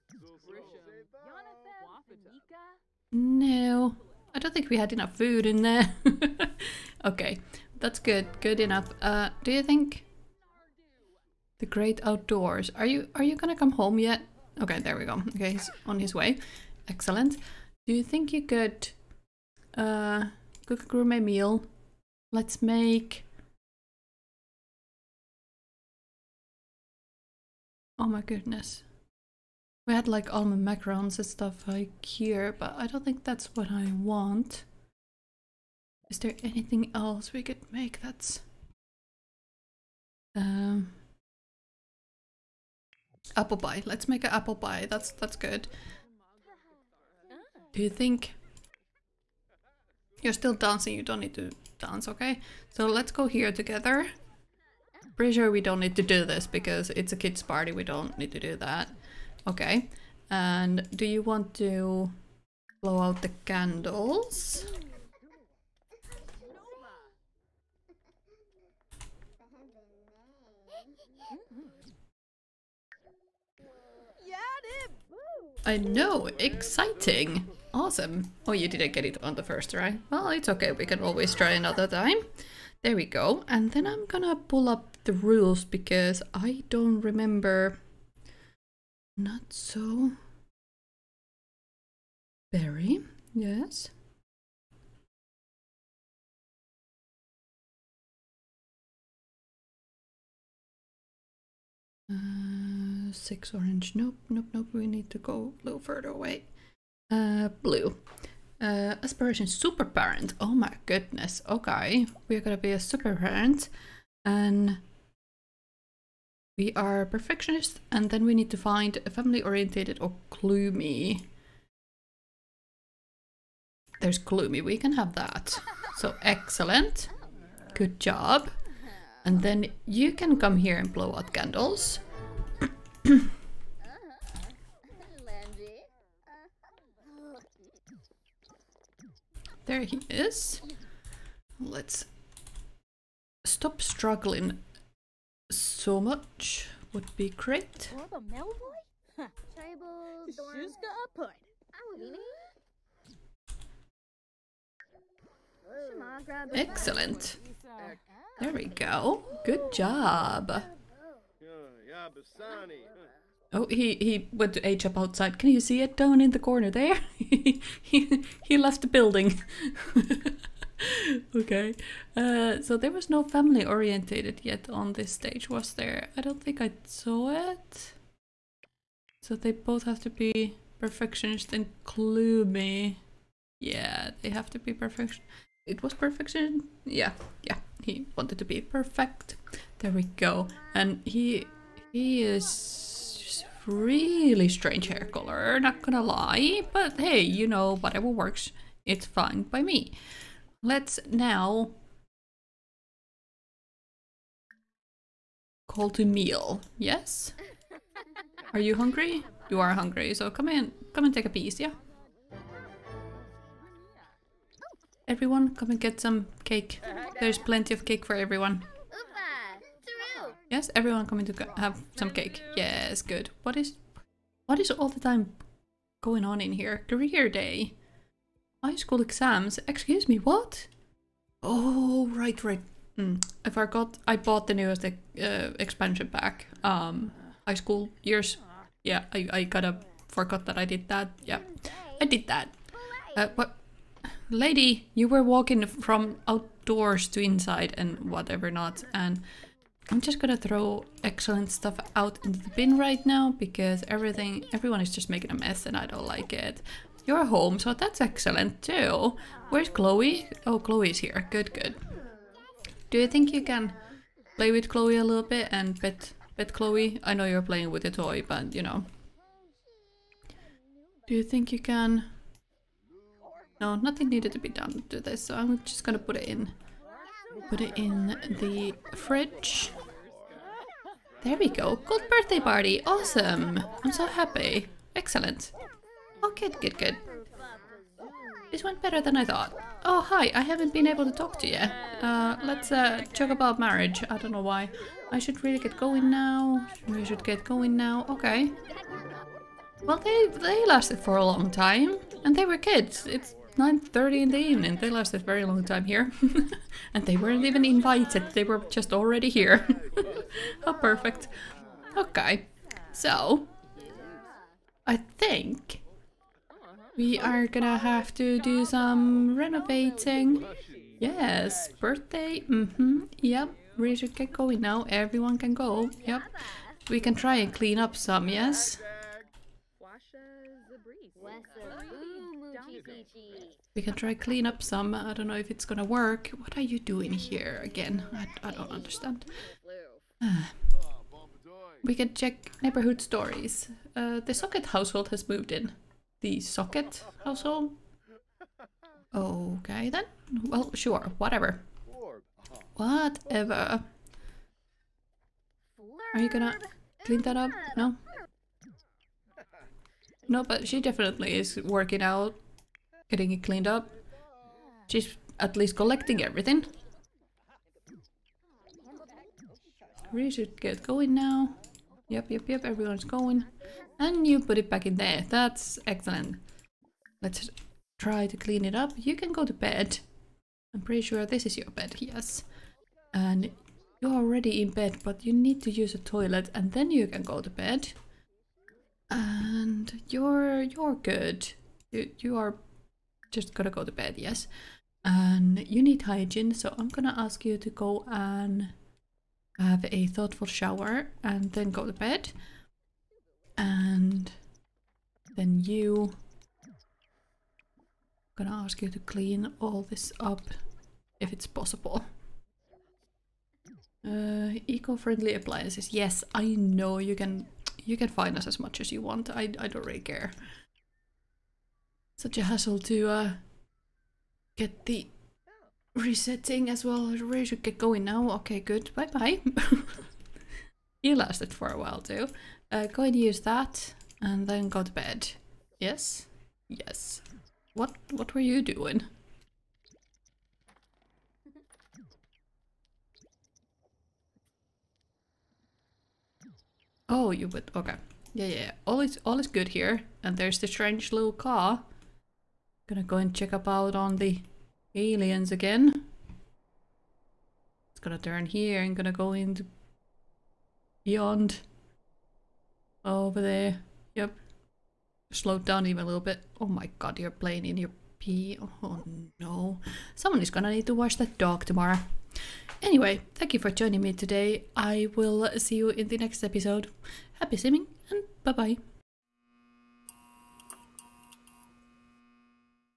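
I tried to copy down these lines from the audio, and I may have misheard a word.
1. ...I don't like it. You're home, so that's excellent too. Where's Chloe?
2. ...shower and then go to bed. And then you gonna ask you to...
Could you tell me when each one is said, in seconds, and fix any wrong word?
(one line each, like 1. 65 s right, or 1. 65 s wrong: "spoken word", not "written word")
1. 255 s right
2. 400 s right.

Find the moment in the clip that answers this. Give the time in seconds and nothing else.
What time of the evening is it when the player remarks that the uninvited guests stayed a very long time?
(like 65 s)
303 s.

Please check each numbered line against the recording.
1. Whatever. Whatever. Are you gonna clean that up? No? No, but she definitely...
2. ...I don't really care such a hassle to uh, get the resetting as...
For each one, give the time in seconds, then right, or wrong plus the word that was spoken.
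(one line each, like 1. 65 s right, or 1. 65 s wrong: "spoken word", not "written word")
1. 351 s right
2. 419 s right.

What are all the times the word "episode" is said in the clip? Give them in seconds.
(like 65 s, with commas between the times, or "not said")
476 s.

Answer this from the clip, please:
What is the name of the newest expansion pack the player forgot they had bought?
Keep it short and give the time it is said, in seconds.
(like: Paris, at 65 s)
High school years, at 237 s.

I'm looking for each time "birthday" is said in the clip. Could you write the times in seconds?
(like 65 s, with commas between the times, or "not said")
282 s, 321 s.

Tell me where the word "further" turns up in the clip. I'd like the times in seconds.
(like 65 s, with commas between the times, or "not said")
105 s.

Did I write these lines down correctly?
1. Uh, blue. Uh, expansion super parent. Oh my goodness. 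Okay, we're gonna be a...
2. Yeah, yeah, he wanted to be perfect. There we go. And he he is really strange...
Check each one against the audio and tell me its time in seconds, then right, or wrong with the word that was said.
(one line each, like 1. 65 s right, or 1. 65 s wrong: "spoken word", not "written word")
1. 107 s wrong: "aspiration", not "expansion"
2. 186 s right.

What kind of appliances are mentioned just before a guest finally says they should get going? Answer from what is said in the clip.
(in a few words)
Eco-friendly appliances.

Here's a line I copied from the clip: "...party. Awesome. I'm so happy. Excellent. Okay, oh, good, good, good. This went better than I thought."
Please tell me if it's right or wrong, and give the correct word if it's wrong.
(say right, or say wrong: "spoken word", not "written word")
right.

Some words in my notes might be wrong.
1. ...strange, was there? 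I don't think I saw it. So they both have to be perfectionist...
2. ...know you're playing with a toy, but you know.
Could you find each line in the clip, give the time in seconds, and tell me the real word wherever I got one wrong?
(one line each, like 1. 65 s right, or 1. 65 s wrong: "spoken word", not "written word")
1. 175 s wrong: "stage", not "strange"
2. 267 s right.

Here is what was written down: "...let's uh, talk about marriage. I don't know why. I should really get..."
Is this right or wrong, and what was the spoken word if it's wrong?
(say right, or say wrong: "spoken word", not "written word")
right.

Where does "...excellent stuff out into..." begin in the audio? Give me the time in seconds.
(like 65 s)
251 s.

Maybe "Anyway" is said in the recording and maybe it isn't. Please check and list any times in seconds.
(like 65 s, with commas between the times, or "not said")
472 s.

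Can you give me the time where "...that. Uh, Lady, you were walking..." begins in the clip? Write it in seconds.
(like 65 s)
242 s.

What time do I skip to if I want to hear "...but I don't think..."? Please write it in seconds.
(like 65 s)
32 s.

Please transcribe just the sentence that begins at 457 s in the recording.
It's gonna turn here and gonna go into beyond.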